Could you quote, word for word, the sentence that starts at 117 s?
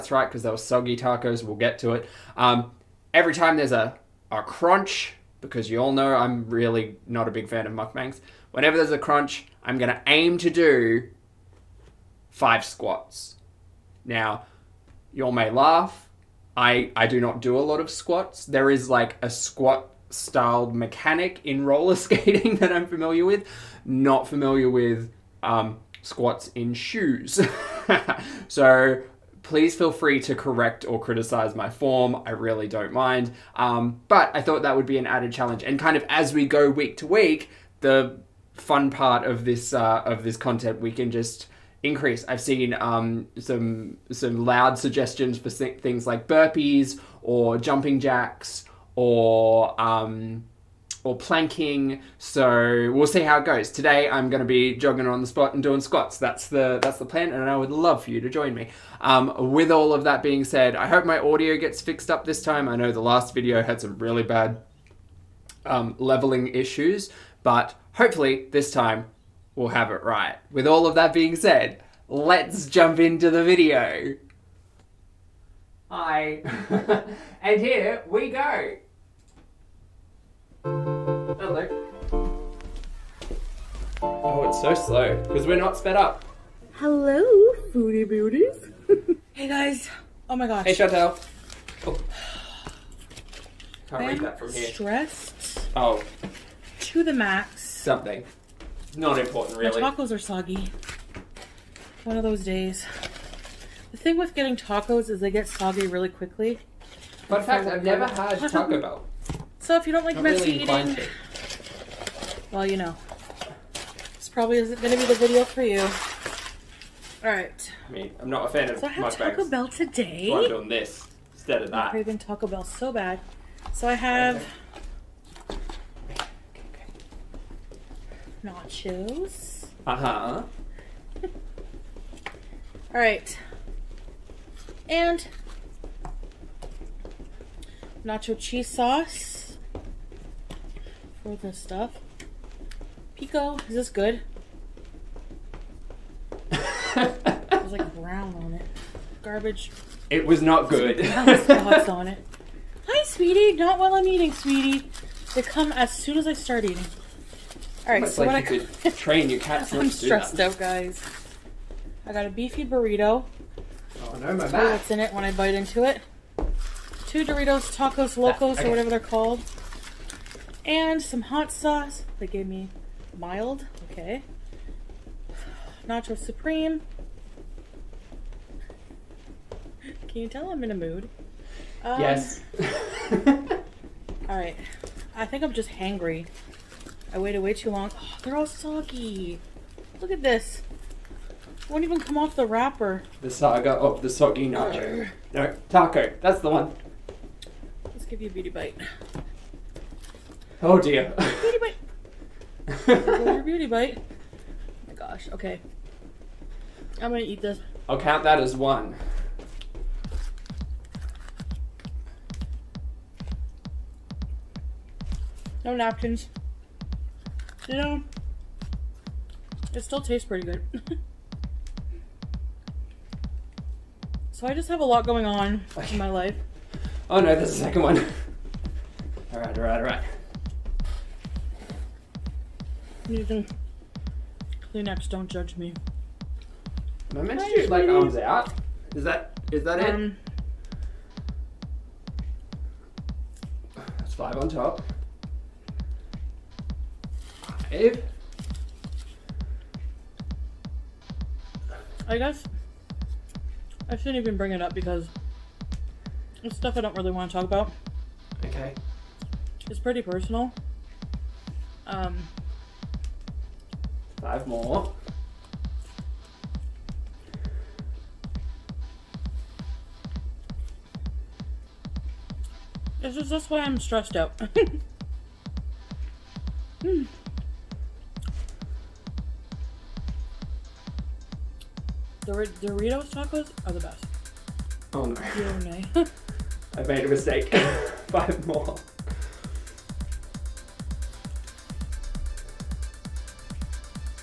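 I mean, I'm not a fan of so I had Taco bags.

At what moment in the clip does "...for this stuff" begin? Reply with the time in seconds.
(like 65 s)
141 s.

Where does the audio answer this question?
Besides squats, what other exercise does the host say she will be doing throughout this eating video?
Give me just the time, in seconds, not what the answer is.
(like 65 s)
54 s.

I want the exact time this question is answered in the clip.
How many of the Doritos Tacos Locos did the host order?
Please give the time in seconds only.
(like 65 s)
167 s.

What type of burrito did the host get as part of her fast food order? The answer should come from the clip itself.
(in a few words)
Beefy burrito.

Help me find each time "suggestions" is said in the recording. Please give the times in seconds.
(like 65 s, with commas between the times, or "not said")
44 s.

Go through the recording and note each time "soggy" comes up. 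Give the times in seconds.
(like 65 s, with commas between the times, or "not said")
0 s, 100 s, 105 s, 188 s, 194 s.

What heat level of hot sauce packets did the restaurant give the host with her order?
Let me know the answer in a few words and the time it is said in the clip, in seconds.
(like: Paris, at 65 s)
Mild, at 173 s.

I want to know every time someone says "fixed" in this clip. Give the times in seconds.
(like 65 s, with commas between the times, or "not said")
61 s.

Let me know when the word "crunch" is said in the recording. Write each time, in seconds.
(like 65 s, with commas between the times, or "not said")
4 s, 8 s.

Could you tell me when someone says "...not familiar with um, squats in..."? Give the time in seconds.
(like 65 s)
23 s.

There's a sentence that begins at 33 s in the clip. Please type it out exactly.
Um, but I thought that would be an added challenge.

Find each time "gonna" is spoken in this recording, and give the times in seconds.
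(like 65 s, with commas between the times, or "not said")
9 s, 207 s.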